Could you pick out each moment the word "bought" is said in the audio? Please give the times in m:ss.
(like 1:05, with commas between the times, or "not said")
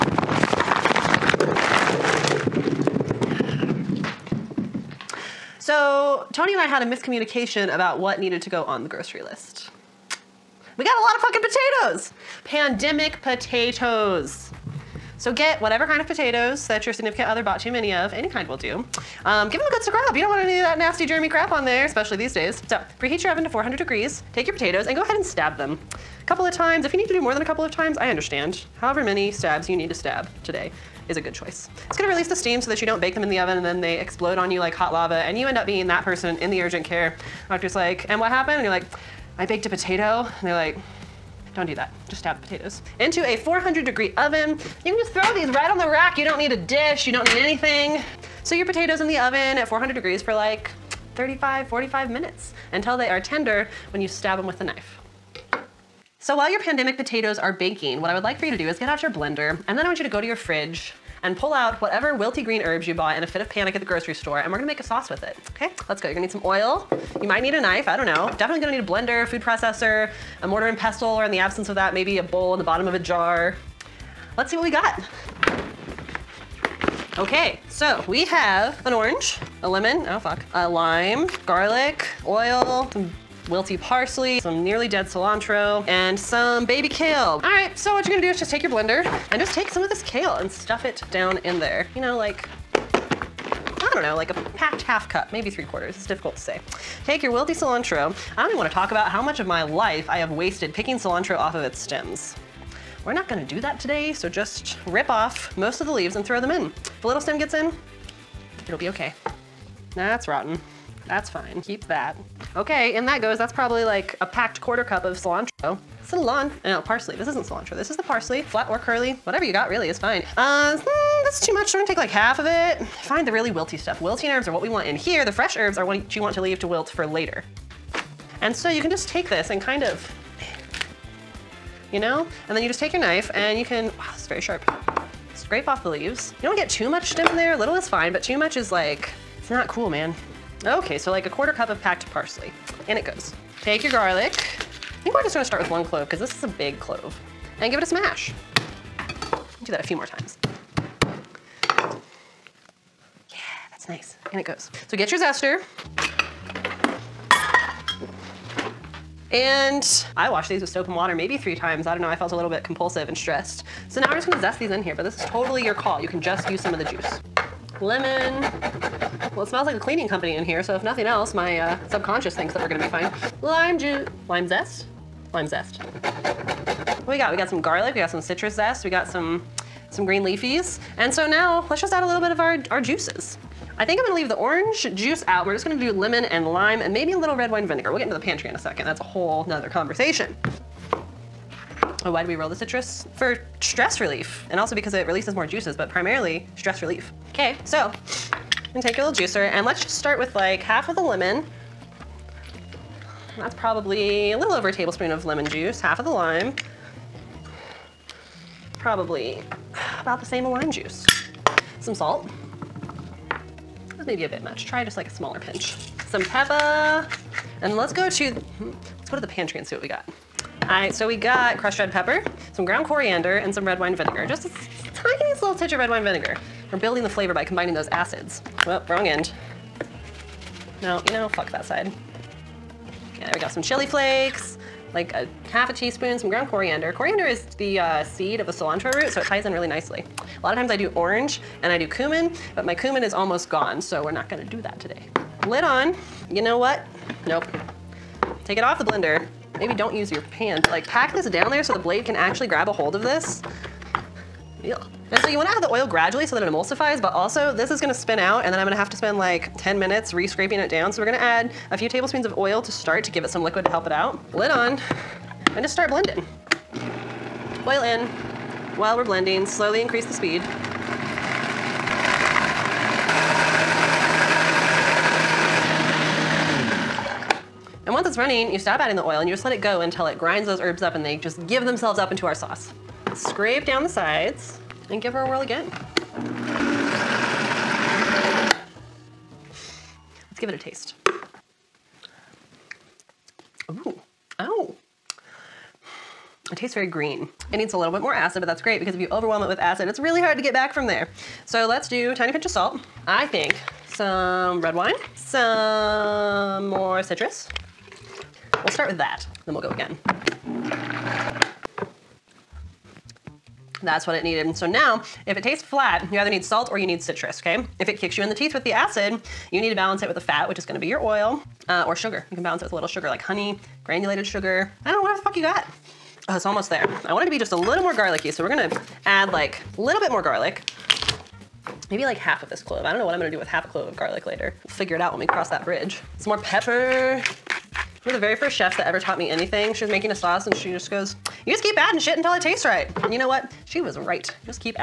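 0:17, 1:02.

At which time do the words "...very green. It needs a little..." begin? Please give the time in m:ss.
4:56.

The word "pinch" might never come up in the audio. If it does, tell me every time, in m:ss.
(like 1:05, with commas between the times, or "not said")
3:35, 5:02.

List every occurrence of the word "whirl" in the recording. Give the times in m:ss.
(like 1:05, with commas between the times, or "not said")
4:45.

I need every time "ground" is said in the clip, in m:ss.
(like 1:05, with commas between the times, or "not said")
3:42, 3:56.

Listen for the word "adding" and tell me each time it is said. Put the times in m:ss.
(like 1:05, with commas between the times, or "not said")
4:38, 5:41.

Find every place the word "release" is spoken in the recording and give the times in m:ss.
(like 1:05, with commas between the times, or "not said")
0:32, 3:15.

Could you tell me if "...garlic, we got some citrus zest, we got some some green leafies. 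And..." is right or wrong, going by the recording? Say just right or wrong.
right.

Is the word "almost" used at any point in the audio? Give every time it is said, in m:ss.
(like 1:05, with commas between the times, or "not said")
4:03, 5:26.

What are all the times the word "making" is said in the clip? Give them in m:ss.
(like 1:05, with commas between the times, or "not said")
5:39.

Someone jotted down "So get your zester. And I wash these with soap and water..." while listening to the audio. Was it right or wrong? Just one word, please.
right.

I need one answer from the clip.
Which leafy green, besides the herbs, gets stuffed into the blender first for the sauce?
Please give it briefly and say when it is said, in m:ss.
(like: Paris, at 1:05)
baby kale, at 1:26.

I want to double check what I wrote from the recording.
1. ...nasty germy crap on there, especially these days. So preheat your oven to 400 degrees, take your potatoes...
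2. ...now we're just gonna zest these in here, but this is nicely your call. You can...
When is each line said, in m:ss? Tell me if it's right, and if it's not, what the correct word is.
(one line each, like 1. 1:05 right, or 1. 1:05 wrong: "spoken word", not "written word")
1. 0:20 right
2. 2:43 wrong: "totally", not "nicely".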